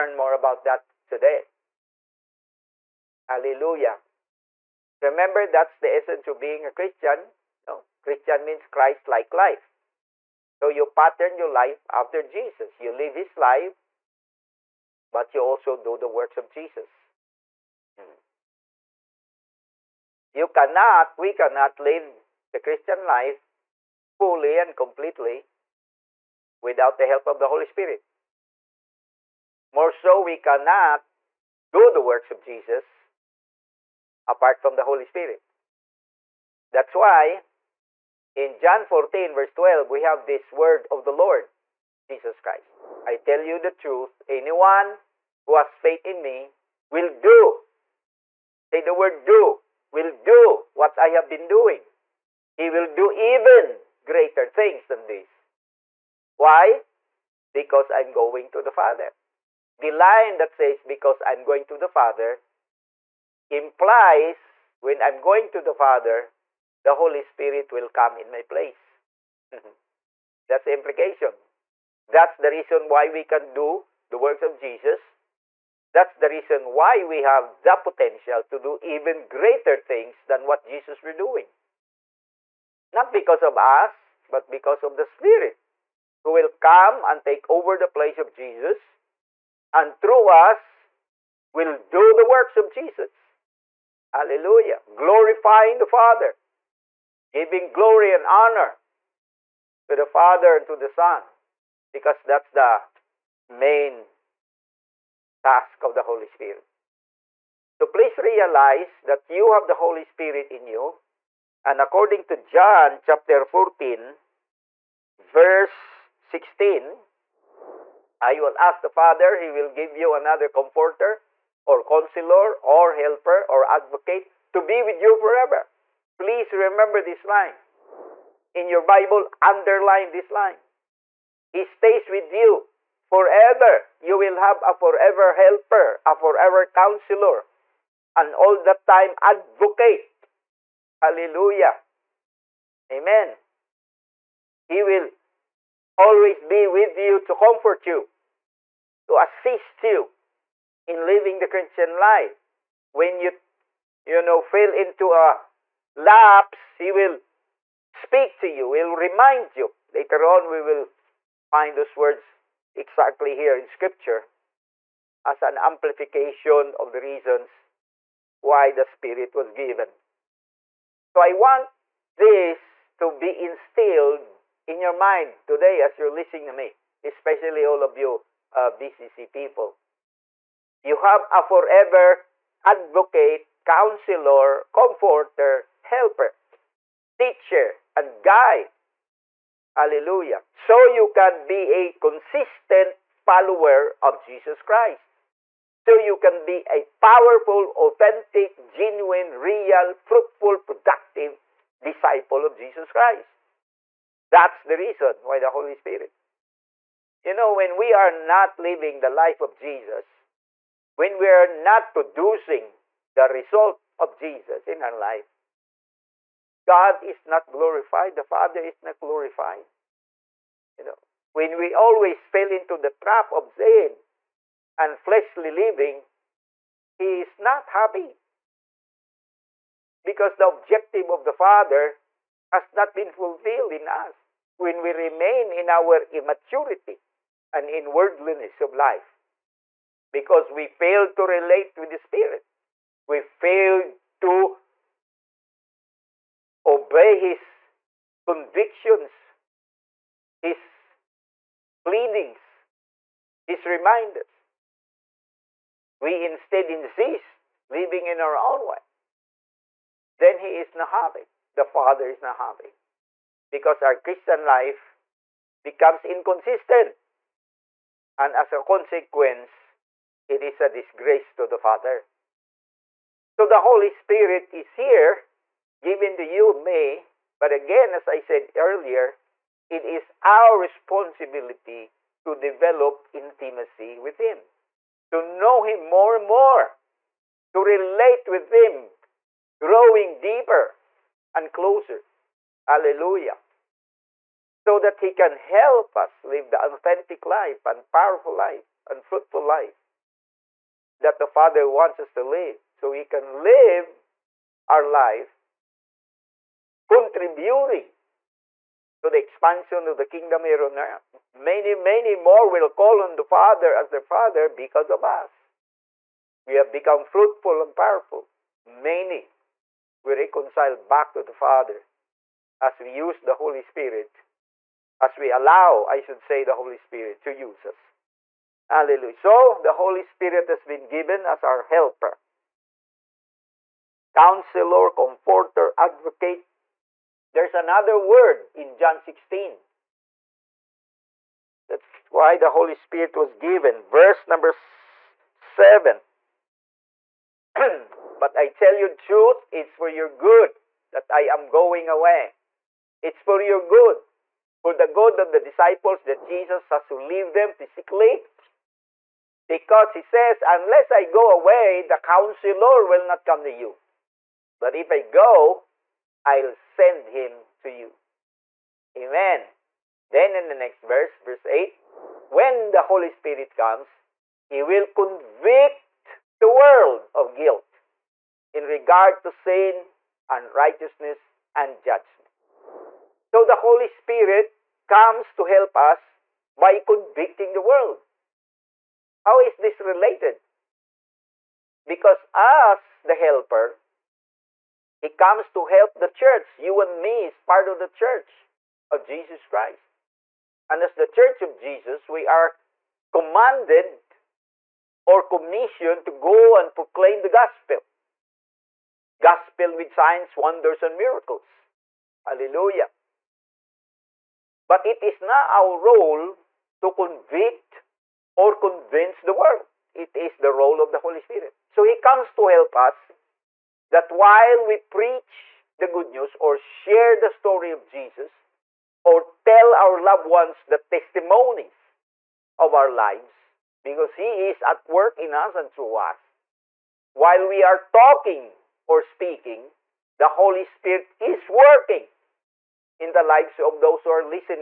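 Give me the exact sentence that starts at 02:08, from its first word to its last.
In your Bible, underline this line.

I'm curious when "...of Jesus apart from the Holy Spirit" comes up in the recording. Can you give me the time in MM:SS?
00:32.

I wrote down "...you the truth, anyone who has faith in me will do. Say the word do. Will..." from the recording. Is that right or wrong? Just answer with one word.
right.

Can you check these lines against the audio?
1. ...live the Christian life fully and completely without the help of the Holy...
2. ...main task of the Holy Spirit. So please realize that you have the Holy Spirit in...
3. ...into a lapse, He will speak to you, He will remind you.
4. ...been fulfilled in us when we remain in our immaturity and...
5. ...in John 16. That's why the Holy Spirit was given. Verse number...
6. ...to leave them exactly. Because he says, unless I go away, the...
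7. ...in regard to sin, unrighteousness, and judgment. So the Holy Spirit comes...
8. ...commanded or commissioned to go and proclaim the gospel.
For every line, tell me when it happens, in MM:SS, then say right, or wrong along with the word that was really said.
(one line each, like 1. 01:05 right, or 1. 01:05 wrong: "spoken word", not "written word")
1. 00:21 right
2. 01:43 right
3. 02:34 right
4. 03:52 right
5. 05:38 right
6. 05:56 wrong: "physically", not "exactly"
7. 06:18 right
8. 06:43 right.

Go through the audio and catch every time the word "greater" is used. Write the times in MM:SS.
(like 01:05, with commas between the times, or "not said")
00:54, 01:19.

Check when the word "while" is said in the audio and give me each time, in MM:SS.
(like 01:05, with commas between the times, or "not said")
07:04, 07:17.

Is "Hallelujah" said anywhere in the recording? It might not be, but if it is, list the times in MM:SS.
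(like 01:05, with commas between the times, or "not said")
00:03, 01:34, 02:20, 03:09, 04:52, 05:28, 06:52.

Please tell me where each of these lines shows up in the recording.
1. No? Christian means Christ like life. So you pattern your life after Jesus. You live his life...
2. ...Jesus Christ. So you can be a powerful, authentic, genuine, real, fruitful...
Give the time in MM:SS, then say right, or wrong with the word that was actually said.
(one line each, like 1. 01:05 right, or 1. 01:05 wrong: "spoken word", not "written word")
1. 00:07 right
2. 03:14 right.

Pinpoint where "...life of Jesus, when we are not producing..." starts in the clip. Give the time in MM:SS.
03:29.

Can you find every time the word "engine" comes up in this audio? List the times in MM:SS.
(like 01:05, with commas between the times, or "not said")
not said.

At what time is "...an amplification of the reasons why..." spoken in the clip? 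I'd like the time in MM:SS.
02:45.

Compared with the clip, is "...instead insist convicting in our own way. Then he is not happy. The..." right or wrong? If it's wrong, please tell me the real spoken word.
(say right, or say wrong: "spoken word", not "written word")
wrong: "living", not "convicting".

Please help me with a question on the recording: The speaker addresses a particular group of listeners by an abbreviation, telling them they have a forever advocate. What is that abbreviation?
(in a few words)
BCC.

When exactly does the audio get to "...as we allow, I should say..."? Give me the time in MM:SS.
05:24.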